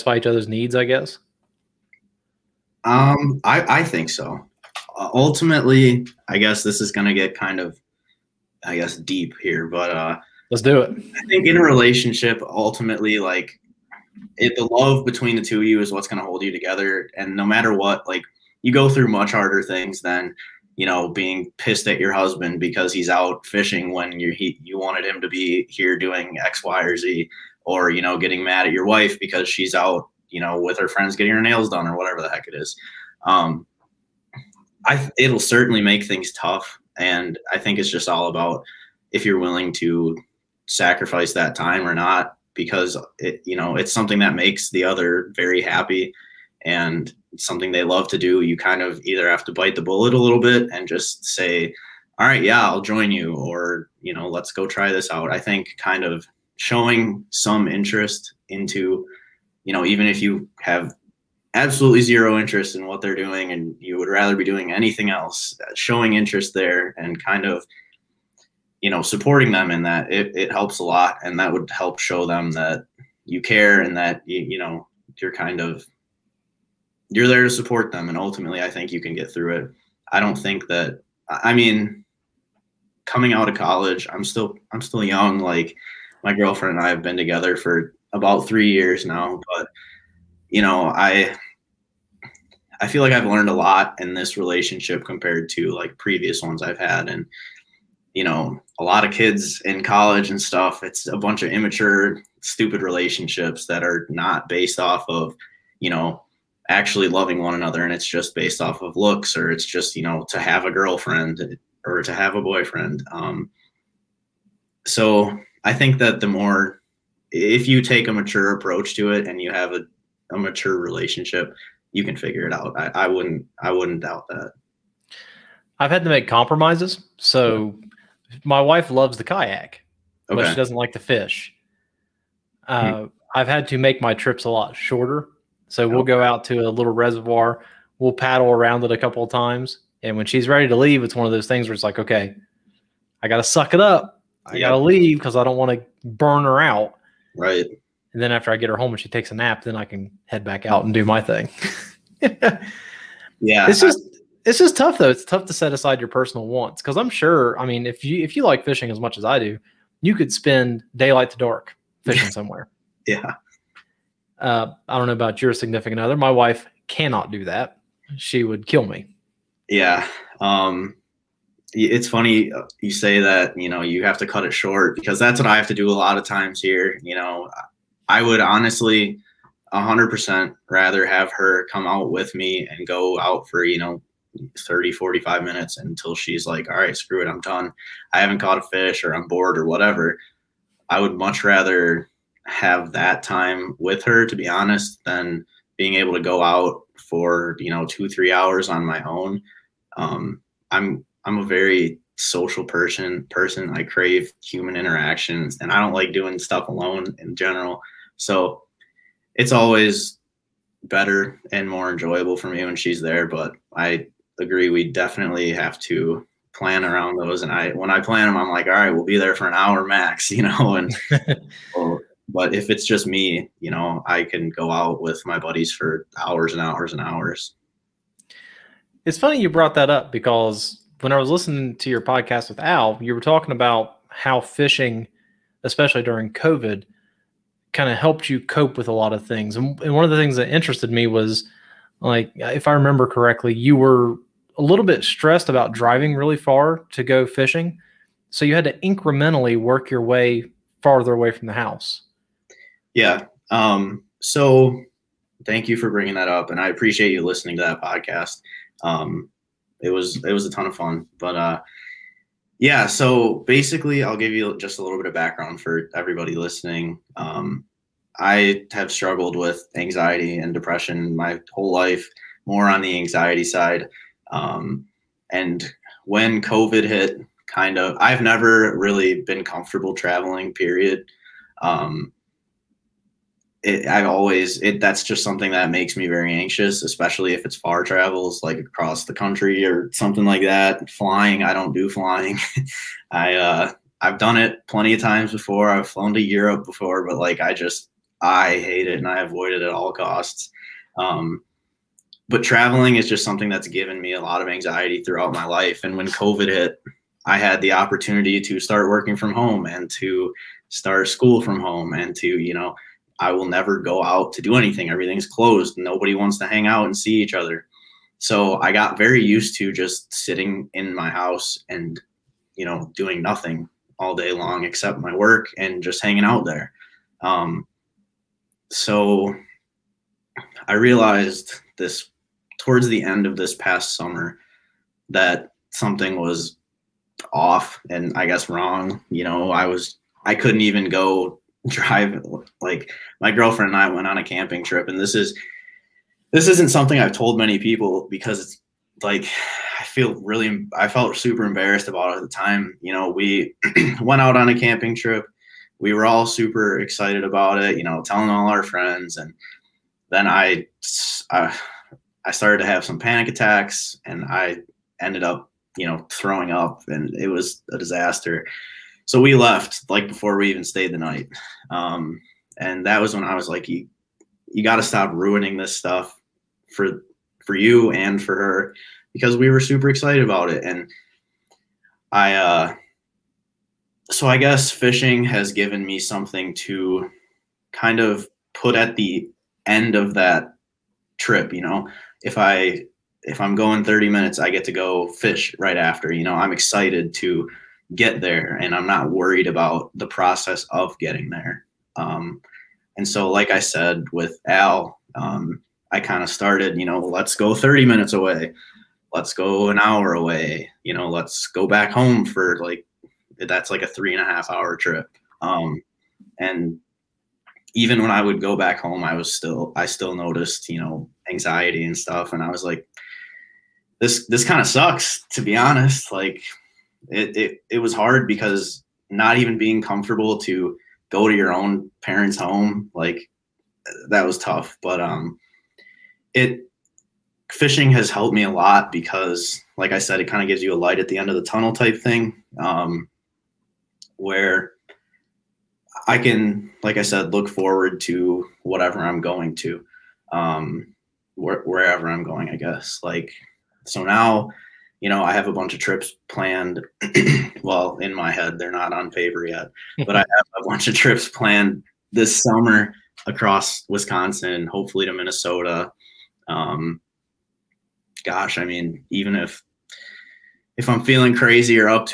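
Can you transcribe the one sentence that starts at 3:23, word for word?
I crave human interactions and I don't like doing stuff alone in general.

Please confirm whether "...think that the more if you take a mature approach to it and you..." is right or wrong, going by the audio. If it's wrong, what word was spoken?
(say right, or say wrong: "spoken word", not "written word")
right.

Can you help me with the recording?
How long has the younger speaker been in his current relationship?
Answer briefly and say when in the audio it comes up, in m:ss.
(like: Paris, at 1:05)
About 3 years, at 1:28.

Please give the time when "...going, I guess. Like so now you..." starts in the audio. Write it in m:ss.
7:32.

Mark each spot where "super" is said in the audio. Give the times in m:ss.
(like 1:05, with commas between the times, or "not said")
5:51, 5:56, 6:19.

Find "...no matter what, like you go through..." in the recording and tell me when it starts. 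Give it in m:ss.
0:17.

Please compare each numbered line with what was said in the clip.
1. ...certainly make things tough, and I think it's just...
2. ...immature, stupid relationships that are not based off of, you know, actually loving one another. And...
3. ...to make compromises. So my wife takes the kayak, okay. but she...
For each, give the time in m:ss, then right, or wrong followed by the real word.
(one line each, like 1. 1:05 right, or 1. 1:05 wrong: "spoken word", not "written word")
1. 0:35 right
2. 1:41 right
3. 2:06 wrong: "loves", not "takes".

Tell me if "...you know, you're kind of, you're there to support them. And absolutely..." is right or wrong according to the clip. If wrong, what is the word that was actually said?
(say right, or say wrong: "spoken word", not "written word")
wrong: "ultimately", not "absolutely".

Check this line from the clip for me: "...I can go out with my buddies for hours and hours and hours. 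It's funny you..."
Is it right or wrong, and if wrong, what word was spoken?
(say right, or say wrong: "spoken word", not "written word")
right.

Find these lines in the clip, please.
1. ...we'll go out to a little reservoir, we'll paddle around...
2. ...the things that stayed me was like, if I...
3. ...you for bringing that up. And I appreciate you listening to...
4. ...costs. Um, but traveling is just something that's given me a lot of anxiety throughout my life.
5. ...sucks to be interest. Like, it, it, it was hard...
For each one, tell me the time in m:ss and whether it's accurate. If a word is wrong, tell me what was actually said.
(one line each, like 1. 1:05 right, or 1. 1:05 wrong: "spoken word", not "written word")
1. 2:15 right
2. 4:00 wrong: "interested", not "stayed"
3. 4:15 right
4. 4:59 right
5. 7:04 wrong: "honest", not "interest".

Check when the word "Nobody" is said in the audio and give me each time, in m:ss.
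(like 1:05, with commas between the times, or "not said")
5:15.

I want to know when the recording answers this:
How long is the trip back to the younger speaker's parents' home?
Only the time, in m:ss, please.
6:53.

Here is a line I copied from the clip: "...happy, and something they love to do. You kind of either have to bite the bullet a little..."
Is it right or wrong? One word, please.
right.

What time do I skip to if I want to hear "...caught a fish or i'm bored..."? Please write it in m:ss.
3:08.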